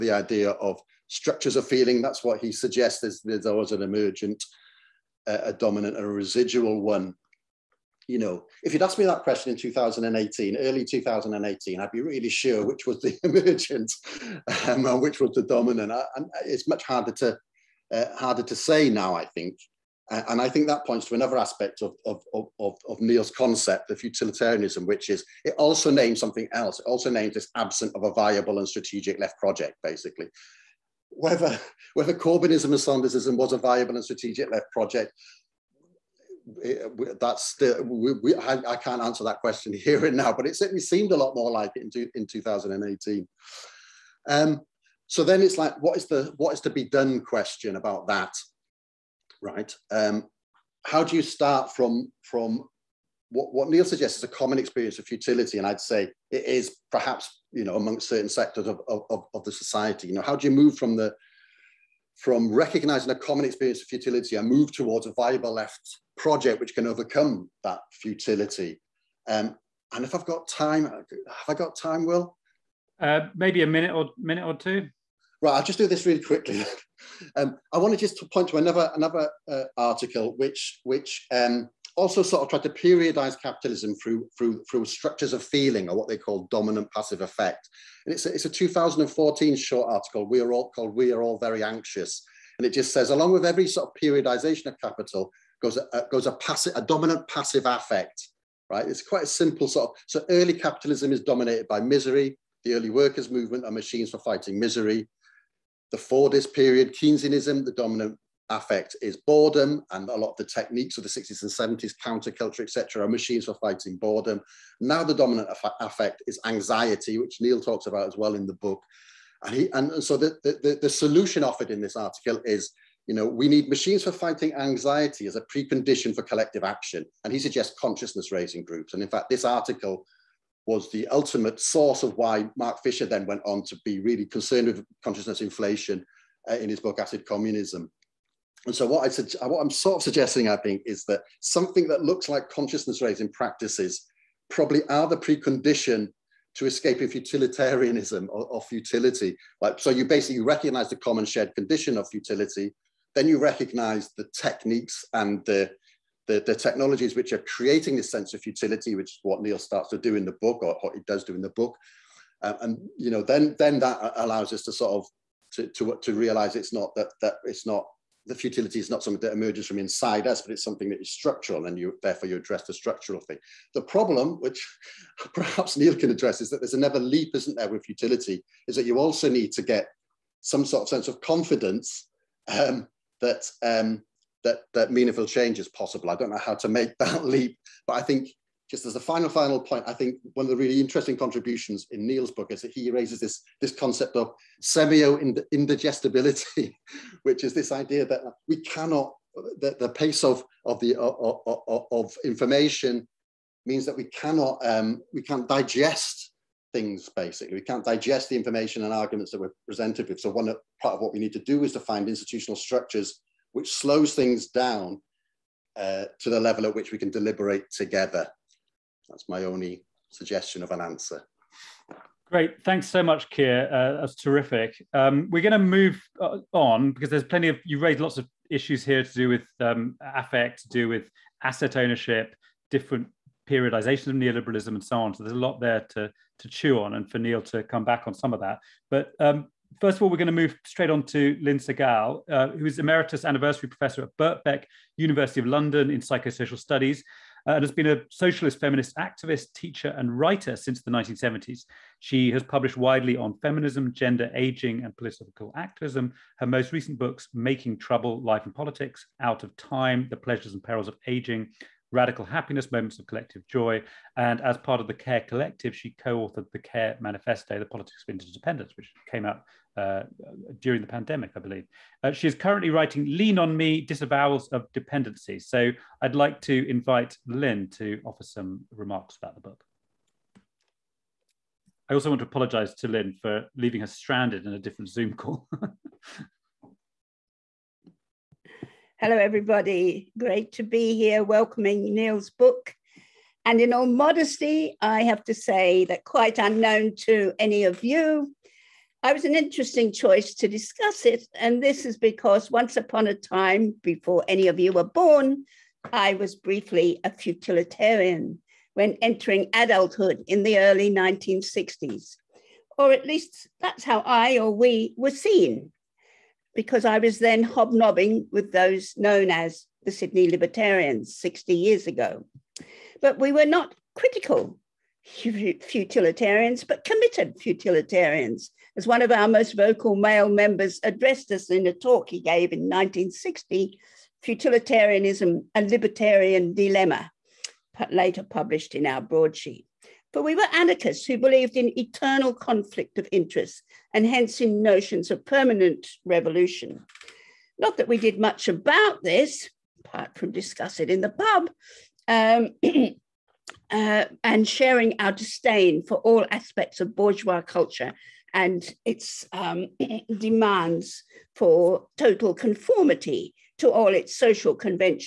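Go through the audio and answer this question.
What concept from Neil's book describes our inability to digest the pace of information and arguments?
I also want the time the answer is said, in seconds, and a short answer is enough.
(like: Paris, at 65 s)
Semio-indigestibility, at 194 s.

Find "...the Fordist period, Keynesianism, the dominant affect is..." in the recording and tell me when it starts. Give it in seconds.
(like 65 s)
105 s.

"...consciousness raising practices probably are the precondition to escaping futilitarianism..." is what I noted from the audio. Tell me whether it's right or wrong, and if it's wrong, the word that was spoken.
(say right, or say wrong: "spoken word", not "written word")
right.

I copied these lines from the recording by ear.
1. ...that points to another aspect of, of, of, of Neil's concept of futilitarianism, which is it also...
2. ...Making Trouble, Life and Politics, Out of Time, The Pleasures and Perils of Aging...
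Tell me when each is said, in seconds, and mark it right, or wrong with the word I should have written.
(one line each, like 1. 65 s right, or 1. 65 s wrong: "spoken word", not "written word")
1. 20 s right
2. 257 s right.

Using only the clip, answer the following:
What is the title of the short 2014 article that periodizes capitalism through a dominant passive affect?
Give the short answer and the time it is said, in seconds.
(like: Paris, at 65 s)
We Are All Very Anxious, at 90 s.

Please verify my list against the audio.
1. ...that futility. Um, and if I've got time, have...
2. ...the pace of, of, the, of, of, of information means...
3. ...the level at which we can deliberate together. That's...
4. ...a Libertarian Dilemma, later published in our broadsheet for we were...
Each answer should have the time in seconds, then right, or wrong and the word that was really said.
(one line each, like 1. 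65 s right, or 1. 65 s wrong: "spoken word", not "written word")
1. 67 s right
2. 199 s right
3. 216 s right
4. 335 s right.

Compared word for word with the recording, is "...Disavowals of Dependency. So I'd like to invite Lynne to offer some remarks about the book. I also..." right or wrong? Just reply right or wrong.
right.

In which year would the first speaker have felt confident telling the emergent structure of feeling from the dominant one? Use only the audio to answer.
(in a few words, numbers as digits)
2018.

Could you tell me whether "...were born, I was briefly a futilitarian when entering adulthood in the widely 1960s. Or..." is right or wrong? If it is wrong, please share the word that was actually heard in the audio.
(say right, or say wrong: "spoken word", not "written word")
wrong: "early", not "widely".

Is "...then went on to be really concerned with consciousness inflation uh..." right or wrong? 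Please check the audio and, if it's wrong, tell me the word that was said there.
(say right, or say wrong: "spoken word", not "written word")
right.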